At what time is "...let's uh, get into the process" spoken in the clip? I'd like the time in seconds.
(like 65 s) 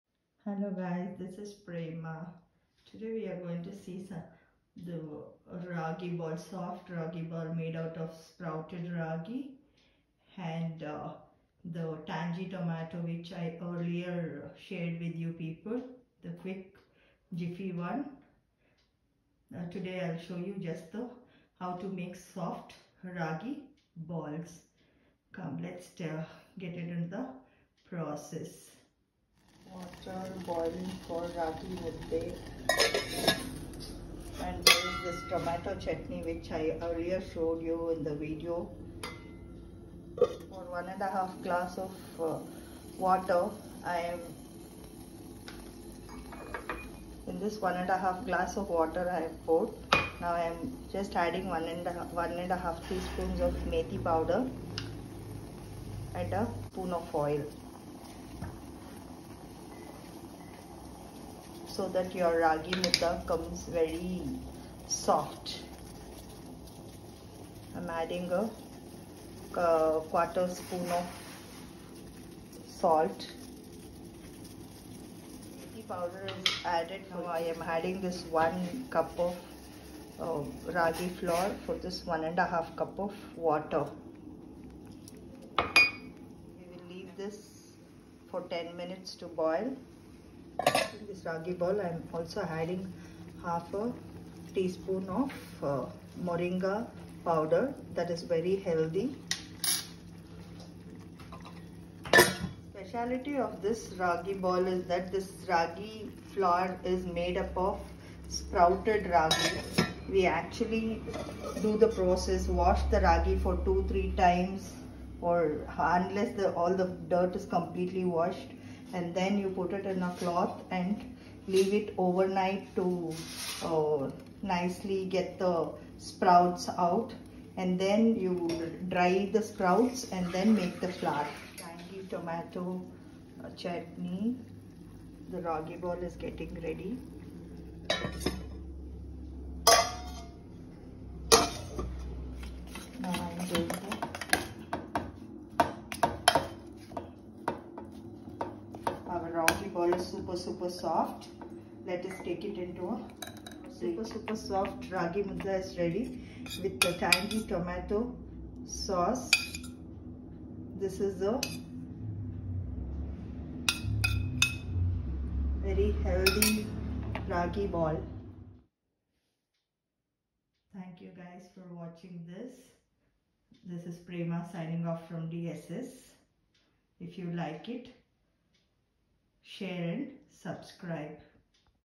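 25 s.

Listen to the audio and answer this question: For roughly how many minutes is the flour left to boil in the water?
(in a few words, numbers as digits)
10 minutes.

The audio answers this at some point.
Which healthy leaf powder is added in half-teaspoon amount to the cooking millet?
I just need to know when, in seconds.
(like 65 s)
96 s.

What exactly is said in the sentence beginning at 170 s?
Thank you guys for watching this.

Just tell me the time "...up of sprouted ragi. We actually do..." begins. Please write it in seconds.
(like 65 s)
107 s.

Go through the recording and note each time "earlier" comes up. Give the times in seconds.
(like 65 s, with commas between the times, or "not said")
13 s, 36 s.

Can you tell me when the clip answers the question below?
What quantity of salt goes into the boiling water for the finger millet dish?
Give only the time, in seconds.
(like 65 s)
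70 s.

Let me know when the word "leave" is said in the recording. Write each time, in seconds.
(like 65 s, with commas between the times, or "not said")
86 s, 121 s.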